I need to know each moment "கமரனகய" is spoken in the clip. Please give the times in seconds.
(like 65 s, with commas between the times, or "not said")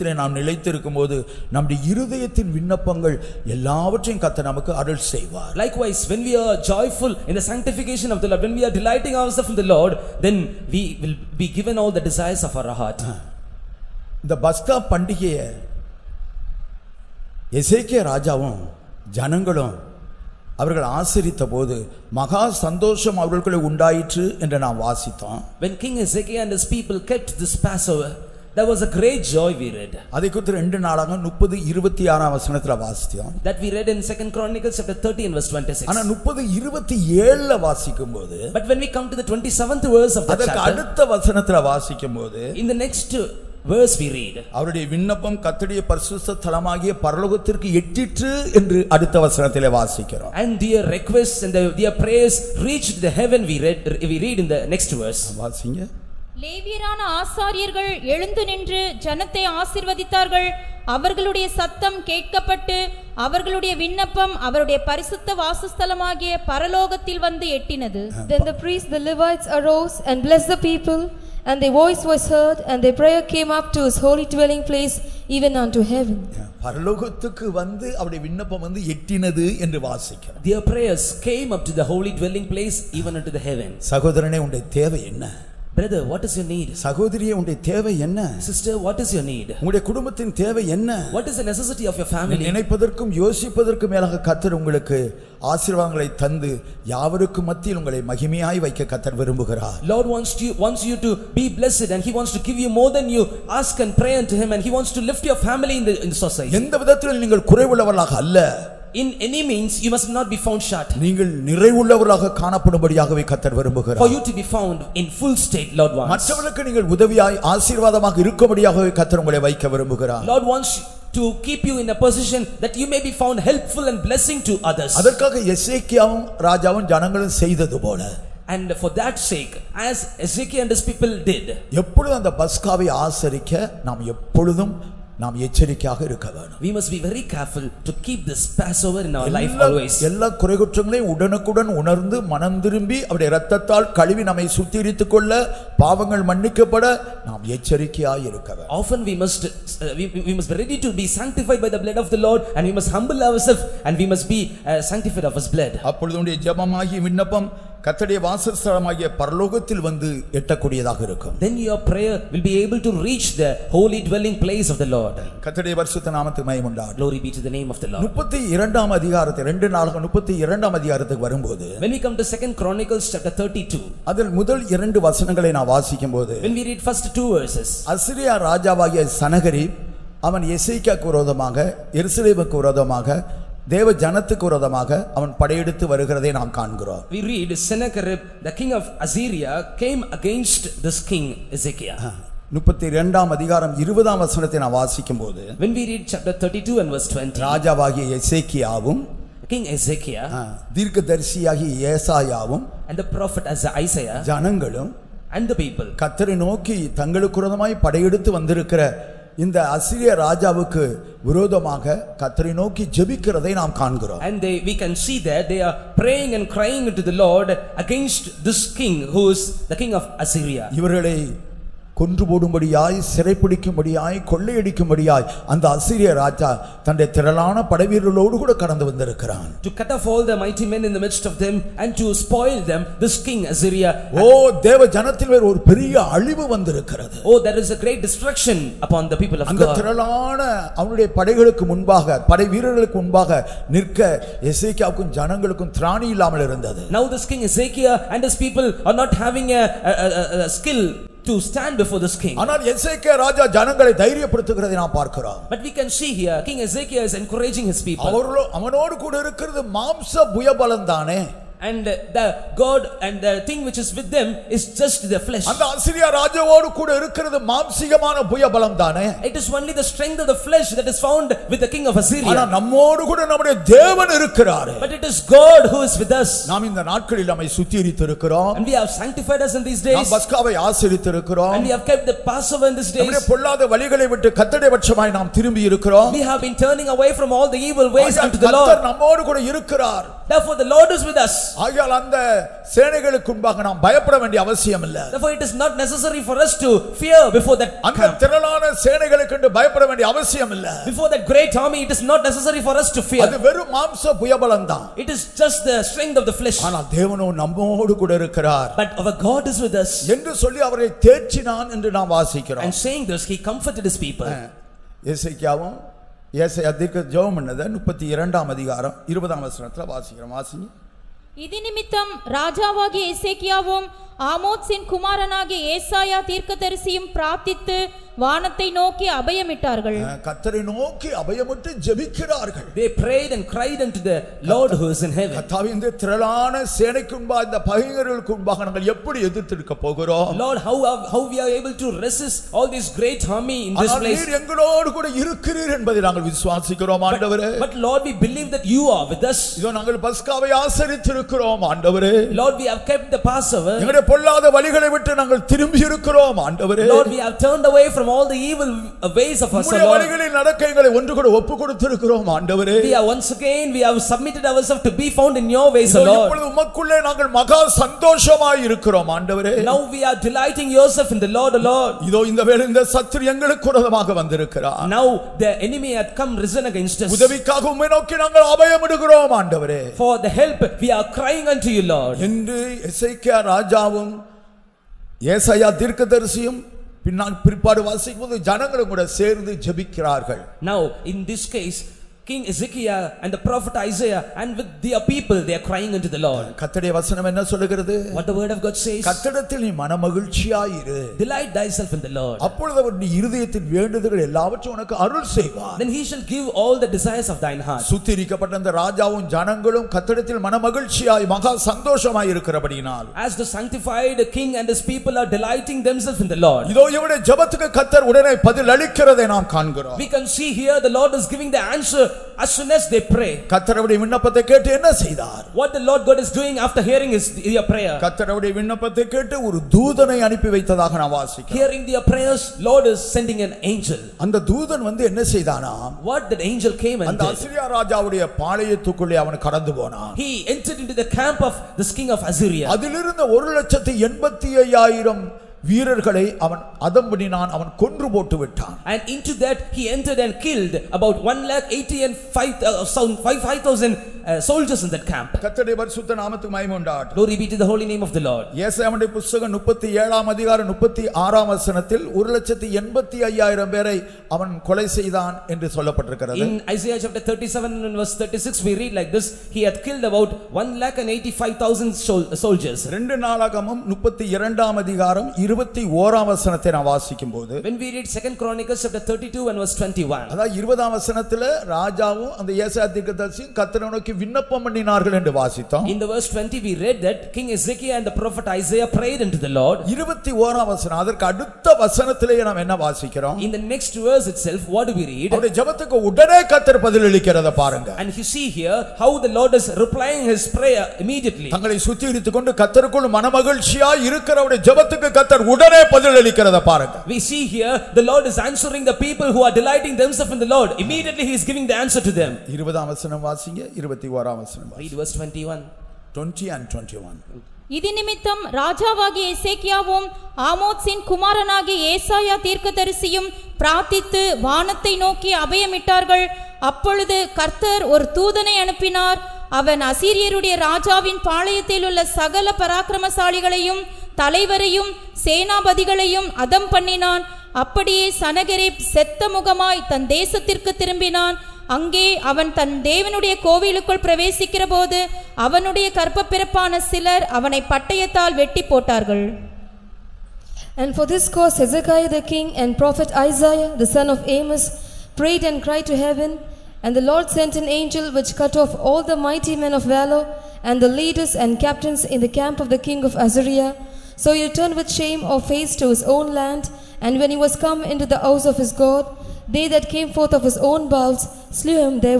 324 s, 521 s.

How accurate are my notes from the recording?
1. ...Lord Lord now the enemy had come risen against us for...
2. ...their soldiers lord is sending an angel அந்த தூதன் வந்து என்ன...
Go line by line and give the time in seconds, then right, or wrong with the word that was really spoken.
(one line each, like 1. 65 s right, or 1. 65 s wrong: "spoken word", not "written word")
1. 371 s right
2. 431 s wrong: "prayers", not "soldiers".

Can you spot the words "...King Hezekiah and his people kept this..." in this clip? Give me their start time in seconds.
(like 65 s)
25 s.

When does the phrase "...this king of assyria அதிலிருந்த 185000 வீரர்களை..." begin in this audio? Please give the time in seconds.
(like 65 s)
441 s.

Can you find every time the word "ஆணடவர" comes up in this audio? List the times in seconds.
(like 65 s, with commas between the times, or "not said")
347 s, 351 s, 356 s.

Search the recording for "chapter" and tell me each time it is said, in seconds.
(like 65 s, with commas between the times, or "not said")
34 s, 40 s, 173 s, 196 s, 467 s, 478 s.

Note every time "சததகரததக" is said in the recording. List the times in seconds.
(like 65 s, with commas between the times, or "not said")
144 s, 501 s.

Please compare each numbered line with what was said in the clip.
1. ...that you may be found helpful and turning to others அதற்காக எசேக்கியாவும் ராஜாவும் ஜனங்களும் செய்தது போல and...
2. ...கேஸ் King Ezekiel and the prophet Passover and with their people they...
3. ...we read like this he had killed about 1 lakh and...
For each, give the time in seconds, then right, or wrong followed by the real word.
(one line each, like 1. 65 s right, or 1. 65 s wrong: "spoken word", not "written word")
1. 122 s wrong: "blessing", not "turning"
2. 391 s wrong: "Isaiah", not "Passover"
3. 468 s right.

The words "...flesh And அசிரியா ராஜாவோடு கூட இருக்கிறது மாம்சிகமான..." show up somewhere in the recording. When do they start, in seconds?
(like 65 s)
265 s.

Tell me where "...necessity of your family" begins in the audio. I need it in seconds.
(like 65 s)
91 s.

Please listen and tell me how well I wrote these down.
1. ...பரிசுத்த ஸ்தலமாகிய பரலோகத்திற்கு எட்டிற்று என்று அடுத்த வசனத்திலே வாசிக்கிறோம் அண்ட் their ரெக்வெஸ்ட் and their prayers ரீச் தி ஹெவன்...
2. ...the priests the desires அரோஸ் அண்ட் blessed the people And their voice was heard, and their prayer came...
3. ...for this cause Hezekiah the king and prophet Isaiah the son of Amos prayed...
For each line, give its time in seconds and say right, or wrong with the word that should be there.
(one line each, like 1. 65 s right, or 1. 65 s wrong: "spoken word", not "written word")
1. 45 s right
2. 68 s wrong: "levites", not "desires"
3. 550 s right.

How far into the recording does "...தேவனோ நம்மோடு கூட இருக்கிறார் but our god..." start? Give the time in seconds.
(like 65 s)
306 s.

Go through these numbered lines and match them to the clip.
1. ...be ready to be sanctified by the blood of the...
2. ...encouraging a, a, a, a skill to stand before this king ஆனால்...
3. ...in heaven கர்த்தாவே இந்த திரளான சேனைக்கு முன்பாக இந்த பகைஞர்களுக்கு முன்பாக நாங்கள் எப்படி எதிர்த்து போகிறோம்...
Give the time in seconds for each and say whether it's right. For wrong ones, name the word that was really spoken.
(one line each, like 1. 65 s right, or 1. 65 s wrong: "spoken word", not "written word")
1. 150 s right
2. 249 s wrong: "having", not "encouraging"
3. 335 s right.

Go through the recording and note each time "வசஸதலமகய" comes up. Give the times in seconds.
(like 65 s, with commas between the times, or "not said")
65 s, 158 s.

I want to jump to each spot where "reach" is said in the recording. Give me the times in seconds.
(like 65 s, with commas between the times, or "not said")
163 s.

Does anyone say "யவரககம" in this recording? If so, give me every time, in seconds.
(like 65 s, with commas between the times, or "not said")
96 s.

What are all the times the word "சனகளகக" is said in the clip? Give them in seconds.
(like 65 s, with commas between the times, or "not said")
292 s, 298 s.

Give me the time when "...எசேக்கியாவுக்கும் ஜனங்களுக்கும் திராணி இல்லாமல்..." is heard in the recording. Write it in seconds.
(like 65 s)
244 s.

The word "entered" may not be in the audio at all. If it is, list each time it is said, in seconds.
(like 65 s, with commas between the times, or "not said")
440 s, 449 s.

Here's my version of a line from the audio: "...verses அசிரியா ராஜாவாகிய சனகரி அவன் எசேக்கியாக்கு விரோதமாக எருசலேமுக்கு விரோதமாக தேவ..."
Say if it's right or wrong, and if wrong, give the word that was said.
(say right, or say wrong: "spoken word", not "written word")
right.